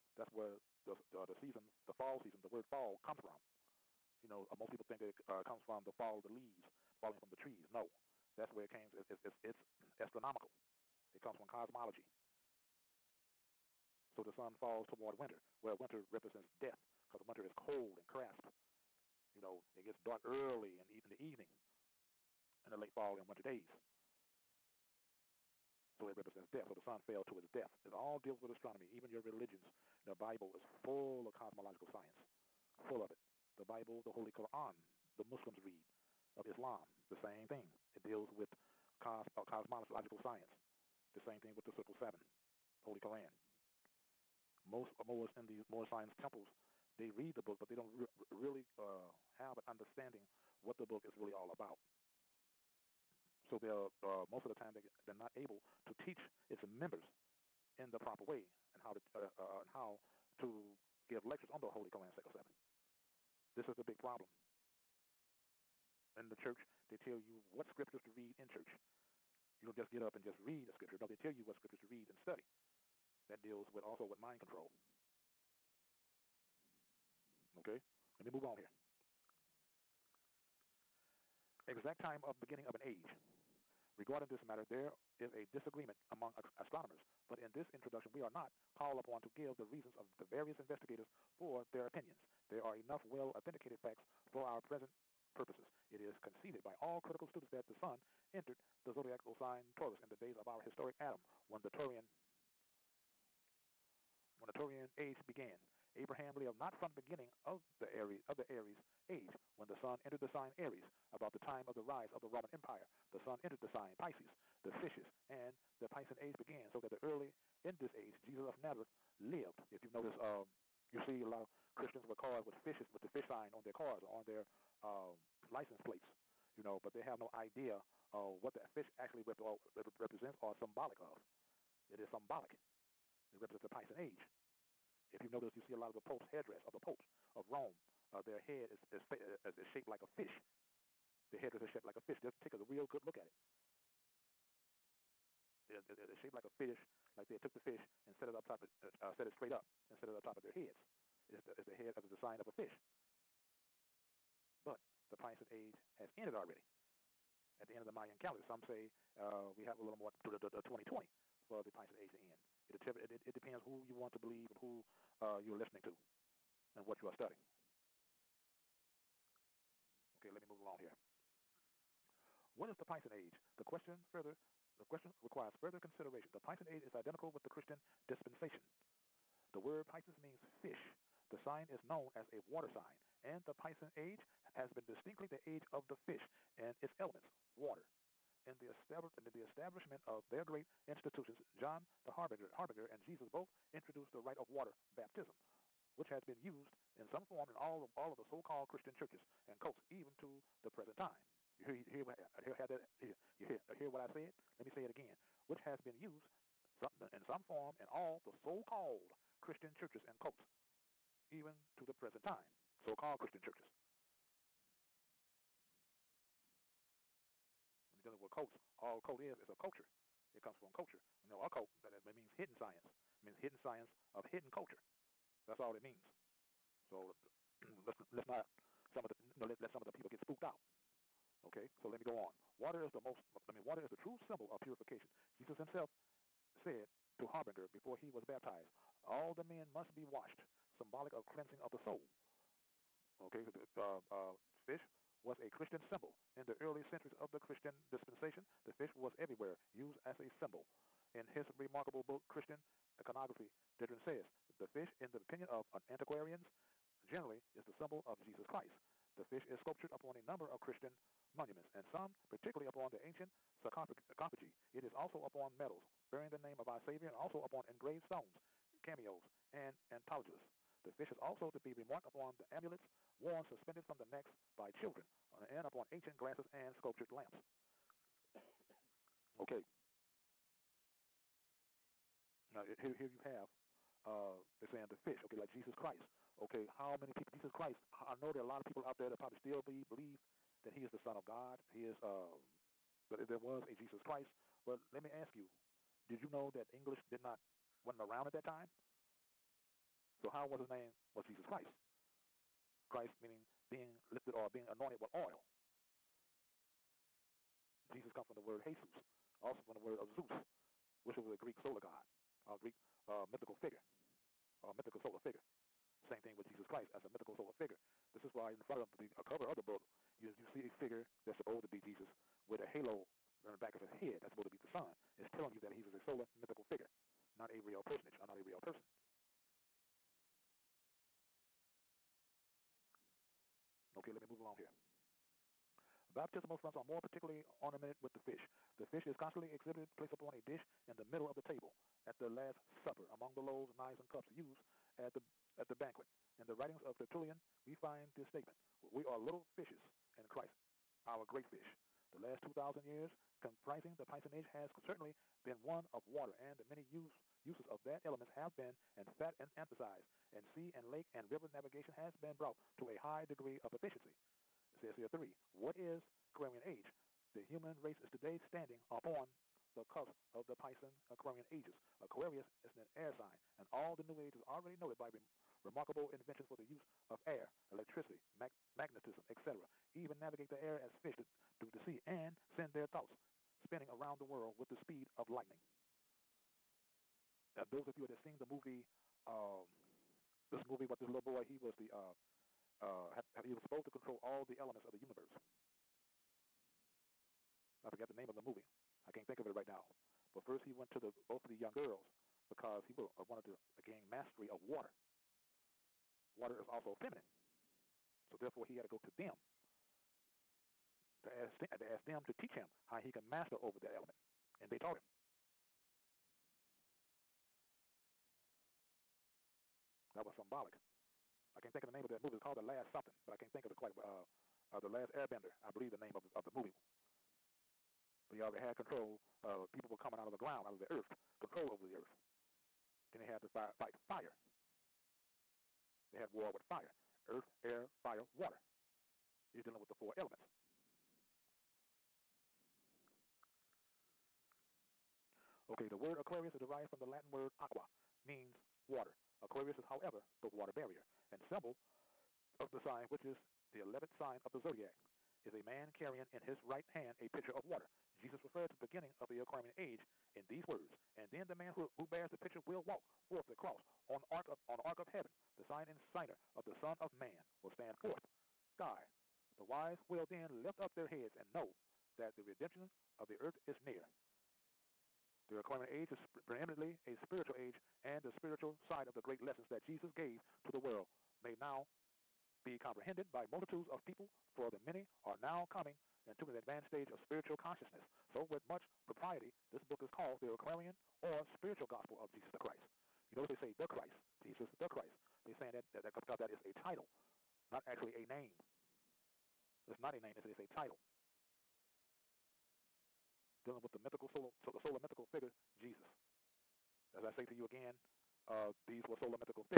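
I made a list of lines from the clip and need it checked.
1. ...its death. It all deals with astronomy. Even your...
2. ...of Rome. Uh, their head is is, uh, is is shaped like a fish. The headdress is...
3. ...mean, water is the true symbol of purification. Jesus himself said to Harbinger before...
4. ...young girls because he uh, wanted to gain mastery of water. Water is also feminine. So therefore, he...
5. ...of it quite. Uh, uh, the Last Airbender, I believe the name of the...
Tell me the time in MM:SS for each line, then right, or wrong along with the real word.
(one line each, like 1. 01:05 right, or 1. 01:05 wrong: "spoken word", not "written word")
1. 00:27 right
2. 02:17 right
3. 03:53 right
4. 06:41 right
5. 07:03 right.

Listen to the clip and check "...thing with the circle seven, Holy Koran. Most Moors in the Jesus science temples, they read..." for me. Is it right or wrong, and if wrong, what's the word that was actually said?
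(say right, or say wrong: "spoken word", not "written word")
wrong: "Moor", not "Jesus".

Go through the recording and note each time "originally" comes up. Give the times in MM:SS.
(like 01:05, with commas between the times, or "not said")
not said.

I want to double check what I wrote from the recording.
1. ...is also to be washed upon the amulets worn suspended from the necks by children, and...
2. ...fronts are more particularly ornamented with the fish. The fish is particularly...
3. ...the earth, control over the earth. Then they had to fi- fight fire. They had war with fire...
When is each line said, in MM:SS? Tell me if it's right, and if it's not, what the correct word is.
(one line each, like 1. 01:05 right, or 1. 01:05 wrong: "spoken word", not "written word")
1. 04:31 wrong: "remarked", not "washed"
2. 05:36 wrong: "constantly", not "particularly"
3. 07:10 right.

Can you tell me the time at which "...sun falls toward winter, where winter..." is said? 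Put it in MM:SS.
00:14.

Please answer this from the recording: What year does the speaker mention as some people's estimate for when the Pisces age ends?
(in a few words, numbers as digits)
2020.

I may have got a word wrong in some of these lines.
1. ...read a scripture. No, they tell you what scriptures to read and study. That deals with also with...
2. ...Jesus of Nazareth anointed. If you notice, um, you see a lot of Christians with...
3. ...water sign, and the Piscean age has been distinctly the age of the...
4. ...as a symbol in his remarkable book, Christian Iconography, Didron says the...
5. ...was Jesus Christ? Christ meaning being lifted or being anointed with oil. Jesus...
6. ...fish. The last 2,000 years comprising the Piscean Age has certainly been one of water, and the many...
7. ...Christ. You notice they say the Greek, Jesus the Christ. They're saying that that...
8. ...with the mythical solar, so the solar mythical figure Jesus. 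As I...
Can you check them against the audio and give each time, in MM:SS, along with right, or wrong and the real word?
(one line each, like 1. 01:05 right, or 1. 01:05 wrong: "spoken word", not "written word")
1. 01:10 right
2. 01:58 wrong: "lived", not "anointed"
3. 03:02 right
4. 04:10 right
5. 05:01 right
6. 05:51 right
7. 08:12 wrong: "Christ", not "Greek"
8. 08:23 right.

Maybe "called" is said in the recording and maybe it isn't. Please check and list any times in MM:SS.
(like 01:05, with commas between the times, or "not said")
01:28, 03:18, 03:28, 03:32, 07:02, 08:10.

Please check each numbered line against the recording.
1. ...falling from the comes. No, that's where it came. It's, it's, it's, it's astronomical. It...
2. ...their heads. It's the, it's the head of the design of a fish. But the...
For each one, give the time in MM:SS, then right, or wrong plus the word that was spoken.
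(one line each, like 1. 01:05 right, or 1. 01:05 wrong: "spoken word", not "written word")
1. 00:07 wrong: "trees", not "comes"
2. 02:30 right.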